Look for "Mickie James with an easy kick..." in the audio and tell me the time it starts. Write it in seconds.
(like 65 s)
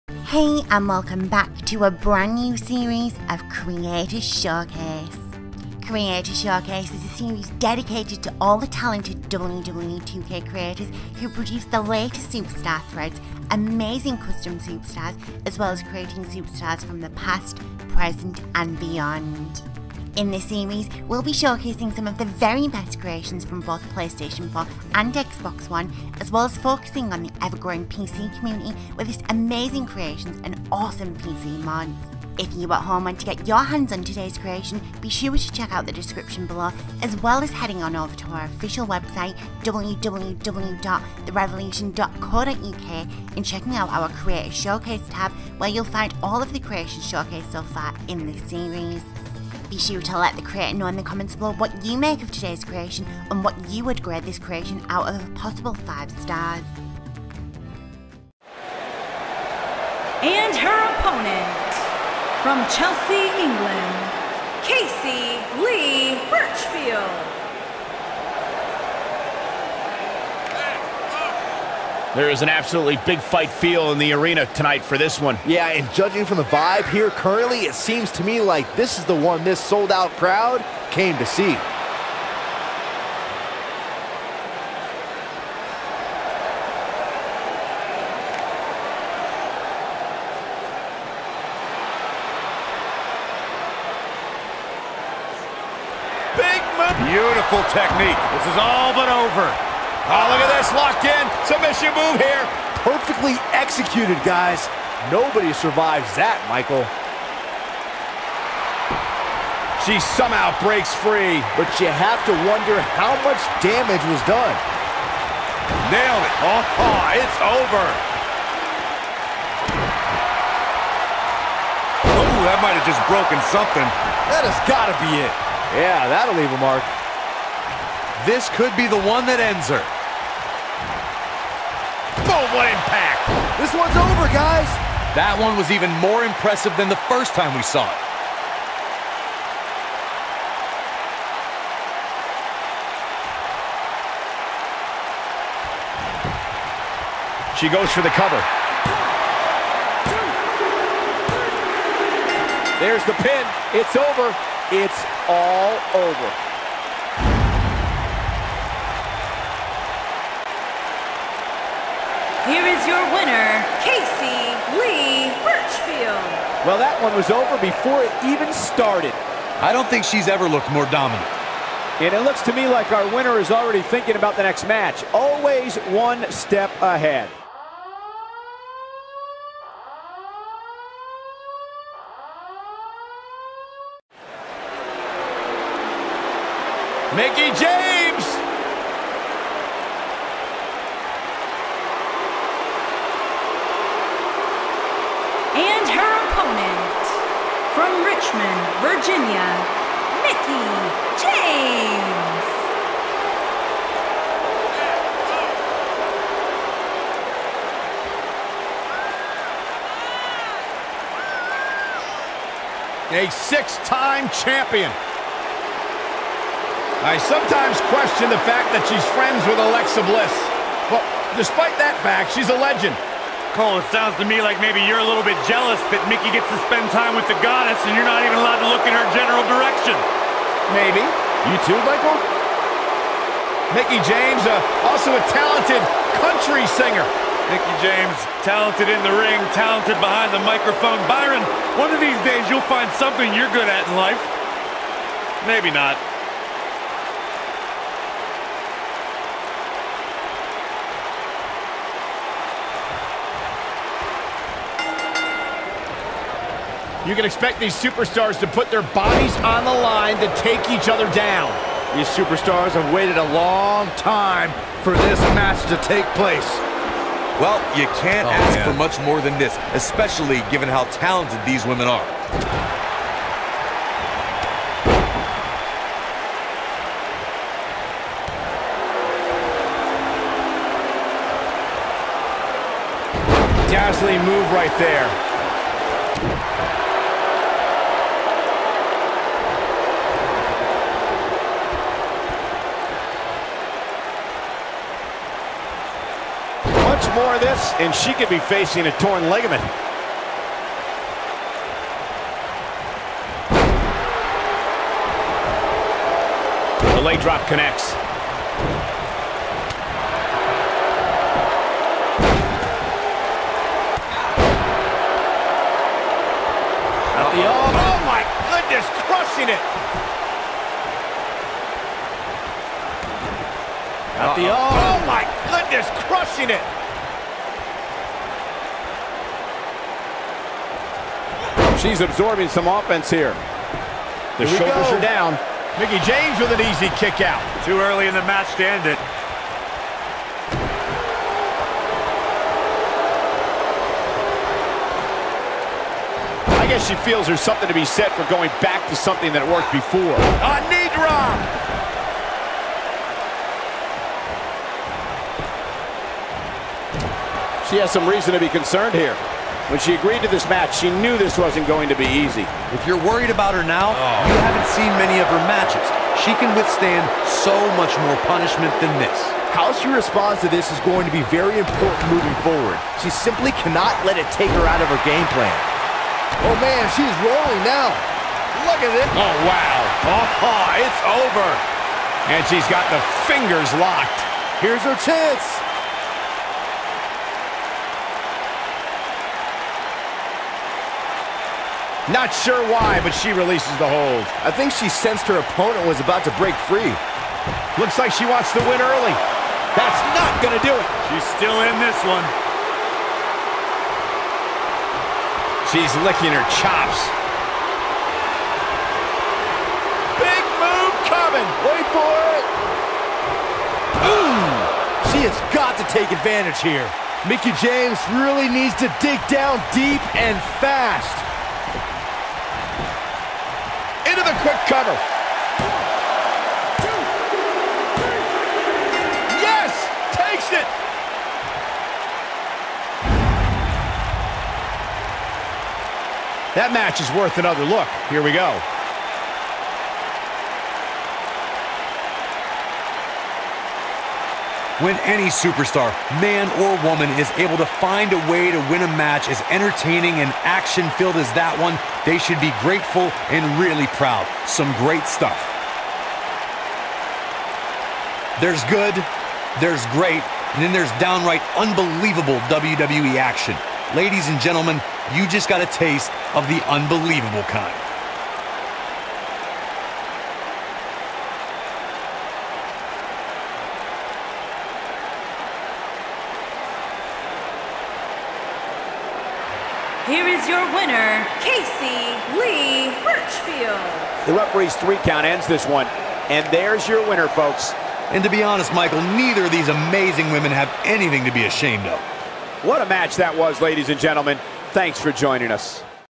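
335 s.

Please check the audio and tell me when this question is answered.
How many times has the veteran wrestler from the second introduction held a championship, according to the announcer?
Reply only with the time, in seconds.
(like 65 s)
213 s.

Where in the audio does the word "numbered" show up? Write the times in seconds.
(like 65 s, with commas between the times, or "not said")
not said.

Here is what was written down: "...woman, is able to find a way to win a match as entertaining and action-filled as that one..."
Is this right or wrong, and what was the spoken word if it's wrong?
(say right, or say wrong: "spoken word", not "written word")
right.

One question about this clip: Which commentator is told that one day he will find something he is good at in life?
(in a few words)
Byron.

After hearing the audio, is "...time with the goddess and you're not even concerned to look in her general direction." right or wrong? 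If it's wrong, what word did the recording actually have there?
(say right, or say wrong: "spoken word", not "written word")
wrong: "allowed", not "concerned".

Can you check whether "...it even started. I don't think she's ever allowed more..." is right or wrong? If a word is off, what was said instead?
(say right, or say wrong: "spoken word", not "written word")
wrong: "looked", not "allowed".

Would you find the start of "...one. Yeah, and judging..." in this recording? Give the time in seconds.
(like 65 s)
75 s.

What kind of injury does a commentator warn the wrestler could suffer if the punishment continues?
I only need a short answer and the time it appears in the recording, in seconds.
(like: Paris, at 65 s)
Torn ligament, at 298 s.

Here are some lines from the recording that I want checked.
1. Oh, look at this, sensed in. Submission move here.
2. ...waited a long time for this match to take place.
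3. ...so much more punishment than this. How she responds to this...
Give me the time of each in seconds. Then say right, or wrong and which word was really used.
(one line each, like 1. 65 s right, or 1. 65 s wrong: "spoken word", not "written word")
1. 100 s wrong: "locked", not "sensed"
2. 262 s right
3. 367 s right.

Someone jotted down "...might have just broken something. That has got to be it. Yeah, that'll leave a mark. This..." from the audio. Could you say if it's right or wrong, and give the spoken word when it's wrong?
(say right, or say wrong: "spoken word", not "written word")
right.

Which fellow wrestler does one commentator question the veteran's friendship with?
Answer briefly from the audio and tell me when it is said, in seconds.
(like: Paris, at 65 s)
Alexa Bliss, at 219 s.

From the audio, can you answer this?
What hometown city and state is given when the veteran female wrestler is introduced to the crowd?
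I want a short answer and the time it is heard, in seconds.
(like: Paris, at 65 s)
Richmond, Virginia, at 198 s.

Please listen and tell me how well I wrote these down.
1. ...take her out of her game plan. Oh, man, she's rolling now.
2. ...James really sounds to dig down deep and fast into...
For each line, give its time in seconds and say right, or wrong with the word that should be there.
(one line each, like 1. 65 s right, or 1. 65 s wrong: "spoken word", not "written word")
1. 374 s right
2. 417 s wrong: "needs", not "sounds".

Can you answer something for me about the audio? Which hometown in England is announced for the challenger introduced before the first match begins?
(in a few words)
Chelsea.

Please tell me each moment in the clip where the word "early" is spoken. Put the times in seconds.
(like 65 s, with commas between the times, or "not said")
337 s, 398 s.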